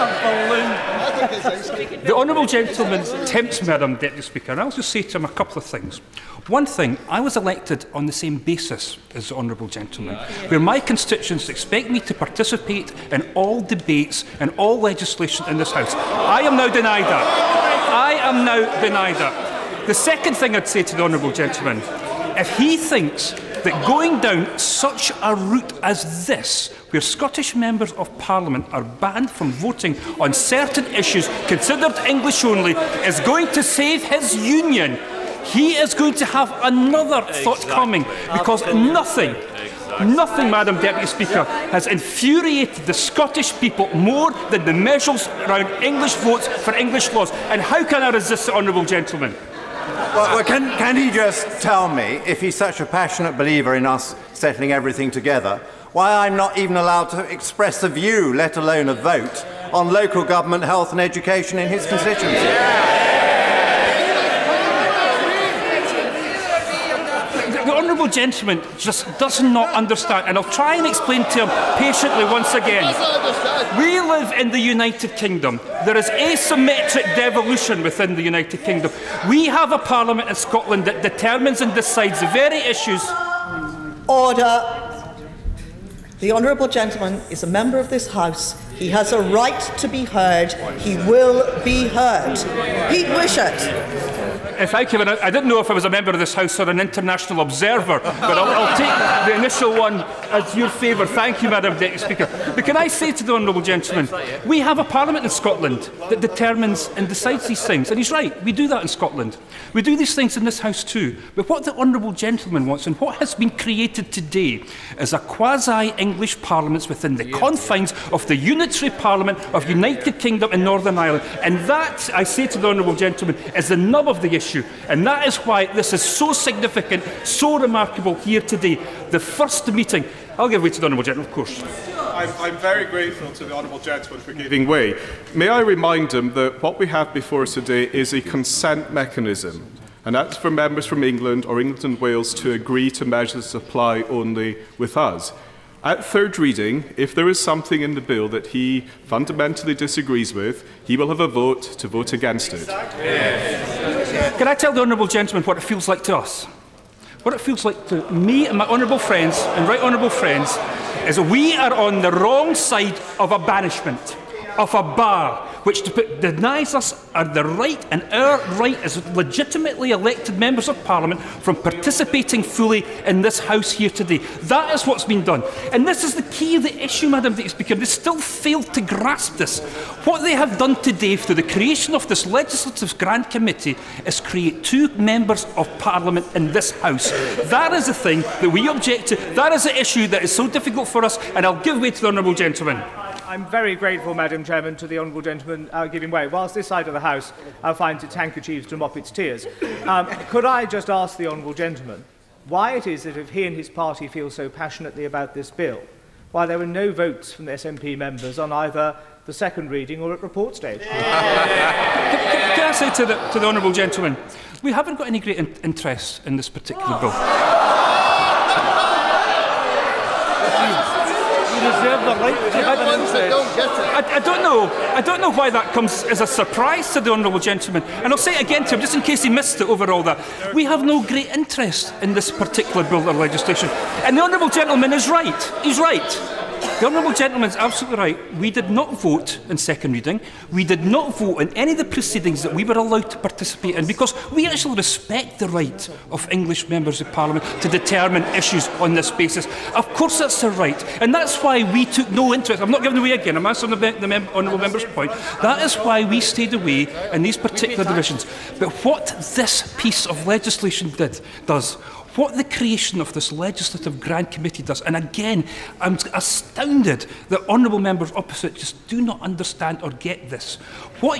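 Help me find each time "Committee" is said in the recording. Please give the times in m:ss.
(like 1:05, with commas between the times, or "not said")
3:03, 4:24.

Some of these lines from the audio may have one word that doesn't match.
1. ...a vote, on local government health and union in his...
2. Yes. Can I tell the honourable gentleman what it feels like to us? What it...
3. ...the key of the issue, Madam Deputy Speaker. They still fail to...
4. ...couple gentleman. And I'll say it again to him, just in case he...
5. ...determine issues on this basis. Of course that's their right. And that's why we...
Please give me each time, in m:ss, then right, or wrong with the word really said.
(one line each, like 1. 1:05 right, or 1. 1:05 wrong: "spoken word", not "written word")
1. 0:58 wrong: "education", not "union"
2. 2:32 right
3. 2:56 right
4. 3:47 wrong: "honourable", not "couple"
5. 4:07 right.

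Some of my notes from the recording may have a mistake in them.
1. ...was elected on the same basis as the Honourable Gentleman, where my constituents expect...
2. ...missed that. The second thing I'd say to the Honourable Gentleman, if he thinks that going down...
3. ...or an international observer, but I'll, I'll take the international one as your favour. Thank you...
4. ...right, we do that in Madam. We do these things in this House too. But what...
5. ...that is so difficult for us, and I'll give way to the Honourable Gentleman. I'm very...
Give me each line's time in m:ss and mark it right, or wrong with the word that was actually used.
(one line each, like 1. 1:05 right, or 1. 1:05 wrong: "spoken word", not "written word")
1. 0:07 right
2. 0:18 wrong: "denied", not "missed"
3. 1:36 wrong: "initial", not "international"
4. 1:48 wrong: "Scotland", not "Madam"
5. 3:10 right.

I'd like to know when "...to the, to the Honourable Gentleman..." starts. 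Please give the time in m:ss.
3:32.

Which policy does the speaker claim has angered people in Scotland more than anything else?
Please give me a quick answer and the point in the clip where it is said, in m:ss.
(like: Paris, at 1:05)
English votes for English laws, at 0:45.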